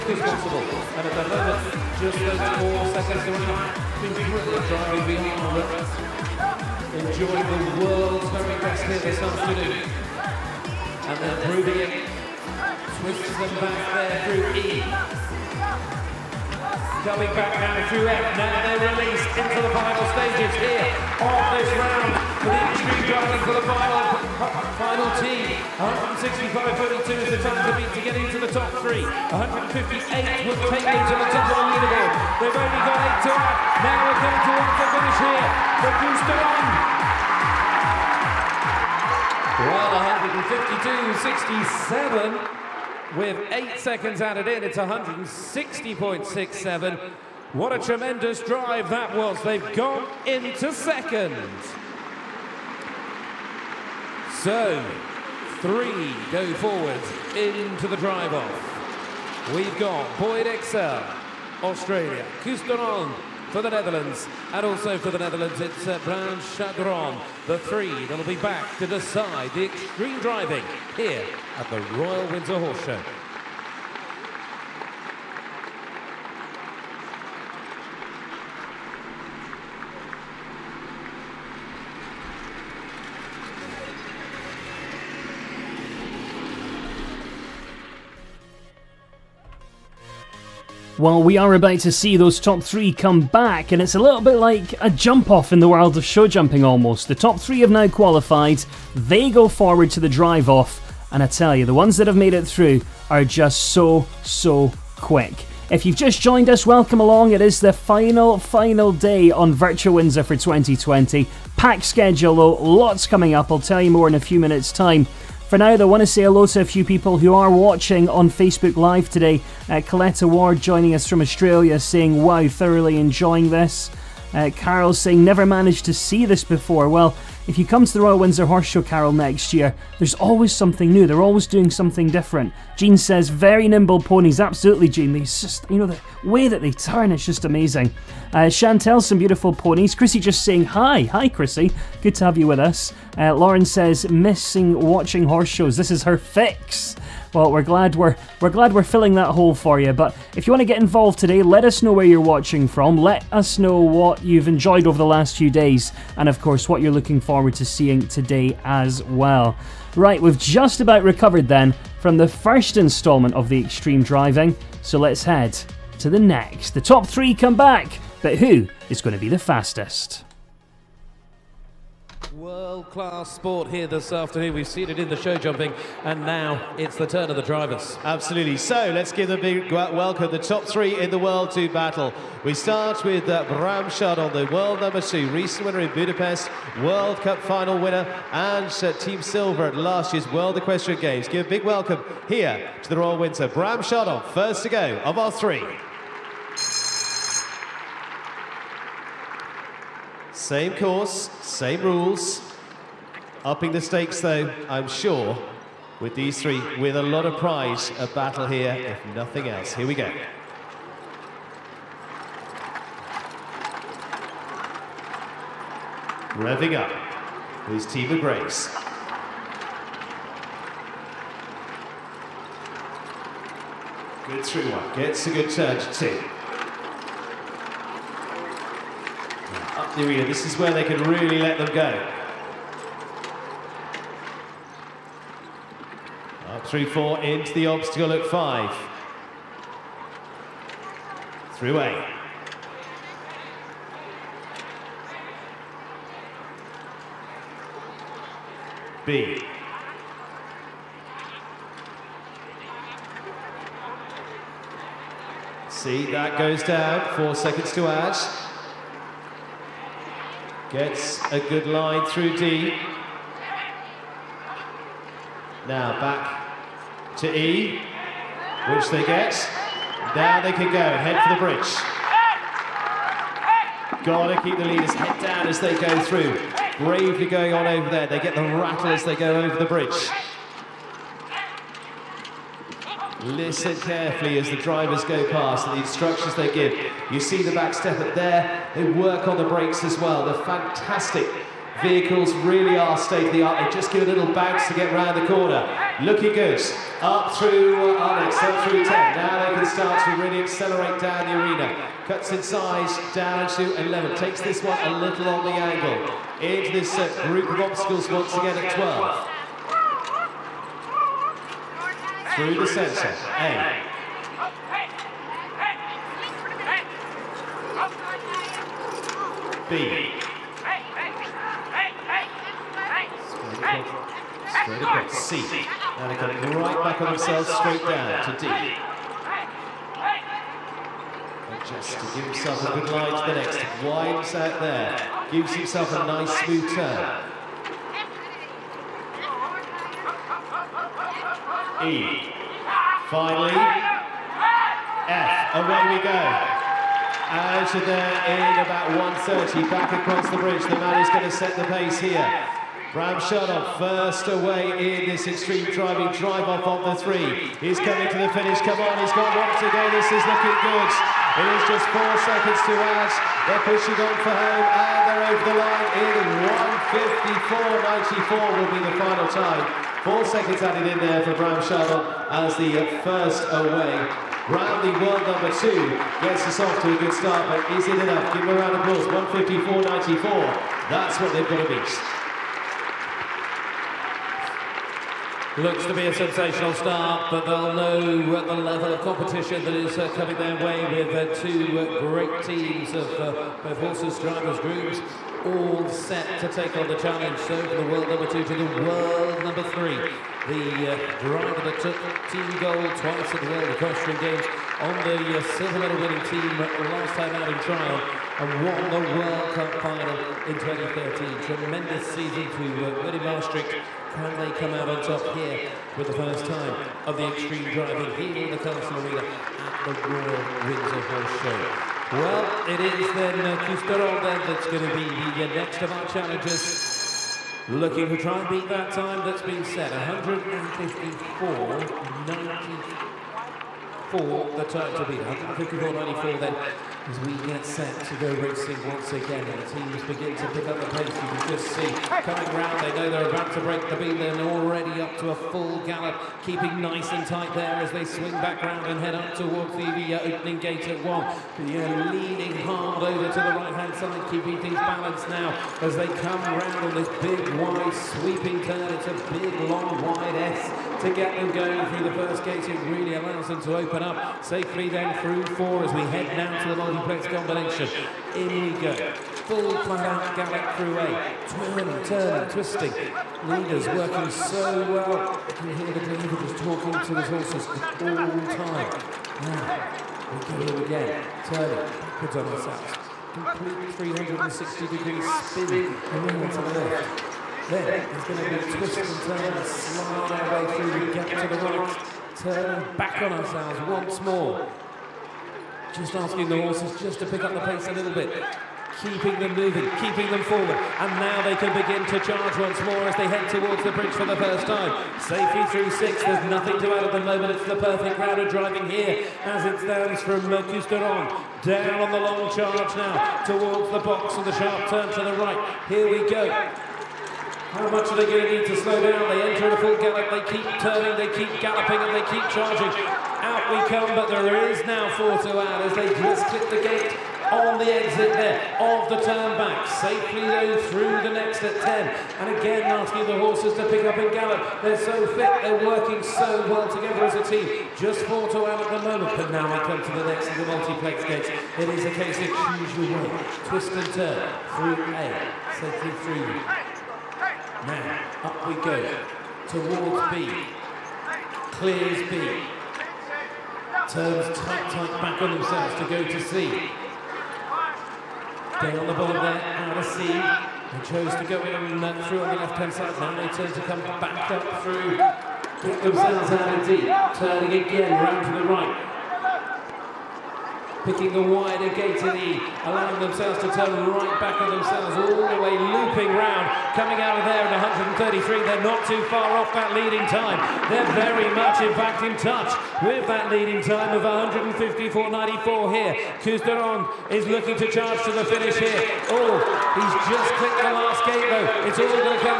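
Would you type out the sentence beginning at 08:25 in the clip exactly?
Safety through six, there's nothing to add at the moment, it's the perfect crowd of driving here as it stands from Mercuscaron.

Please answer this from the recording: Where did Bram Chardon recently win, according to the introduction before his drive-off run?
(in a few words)
Budapest.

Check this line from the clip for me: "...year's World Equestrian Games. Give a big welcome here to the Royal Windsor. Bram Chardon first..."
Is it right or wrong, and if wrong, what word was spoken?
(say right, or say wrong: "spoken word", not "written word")
right.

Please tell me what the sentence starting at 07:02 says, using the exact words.
Well, it is then uh, then that's going to be the uh, next of our challengers.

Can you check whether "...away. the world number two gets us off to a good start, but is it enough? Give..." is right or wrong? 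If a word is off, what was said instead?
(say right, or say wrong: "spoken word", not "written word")
right.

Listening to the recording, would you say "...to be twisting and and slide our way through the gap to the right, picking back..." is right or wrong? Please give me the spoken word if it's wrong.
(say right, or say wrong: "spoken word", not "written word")
wrong: "turning", not "picking".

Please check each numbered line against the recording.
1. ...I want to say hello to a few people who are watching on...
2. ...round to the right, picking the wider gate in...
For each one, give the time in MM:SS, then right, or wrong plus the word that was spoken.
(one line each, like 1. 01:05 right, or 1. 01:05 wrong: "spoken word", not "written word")
1. 01:55 right
2. 09:28 right.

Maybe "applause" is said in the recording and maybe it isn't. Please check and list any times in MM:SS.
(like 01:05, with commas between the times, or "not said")
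06:18.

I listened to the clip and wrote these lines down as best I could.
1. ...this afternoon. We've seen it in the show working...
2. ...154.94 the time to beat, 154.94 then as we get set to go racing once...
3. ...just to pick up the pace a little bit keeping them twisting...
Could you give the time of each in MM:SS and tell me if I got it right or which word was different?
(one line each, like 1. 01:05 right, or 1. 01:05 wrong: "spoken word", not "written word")
1. 02:53 wrong: "jumping", not "working"
2. 07:09 right
3. 08:17 wrong: "moving", not "twisting".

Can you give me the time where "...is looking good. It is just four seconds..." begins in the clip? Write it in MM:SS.
06:00.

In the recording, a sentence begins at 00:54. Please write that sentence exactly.
So, three go forward into the drive off.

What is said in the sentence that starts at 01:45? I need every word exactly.
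If you've just joined us, welcome along.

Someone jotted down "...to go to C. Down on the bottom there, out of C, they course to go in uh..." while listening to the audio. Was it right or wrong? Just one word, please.
wrong.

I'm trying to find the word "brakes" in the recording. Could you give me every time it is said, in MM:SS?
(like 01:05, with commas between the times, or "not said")
04:49.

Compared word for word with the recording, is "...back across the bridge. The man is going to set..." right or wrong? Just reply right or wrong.
right.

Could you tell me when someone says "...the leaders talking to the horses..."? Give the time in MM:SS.
07:55.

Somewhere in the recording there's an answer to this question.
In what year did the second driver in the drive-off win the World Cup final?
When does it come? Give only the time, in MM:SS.
06:50.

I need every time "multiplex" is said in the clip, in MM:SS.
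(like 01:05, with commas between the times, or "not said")
07:46, 09:00.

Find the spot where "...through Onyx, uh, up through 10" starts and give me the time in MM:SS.
04:57.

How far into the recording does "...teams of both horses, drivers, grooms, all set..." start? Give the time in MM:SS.
06:32.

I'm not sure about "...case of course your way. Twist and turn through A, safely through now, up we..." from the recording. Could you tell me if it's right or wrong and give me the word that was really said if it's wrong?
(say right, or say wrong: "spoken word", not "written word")
wrong: "choose", not "course".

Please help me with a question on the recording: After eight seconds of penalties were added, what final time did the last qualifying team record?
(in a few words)
160.67.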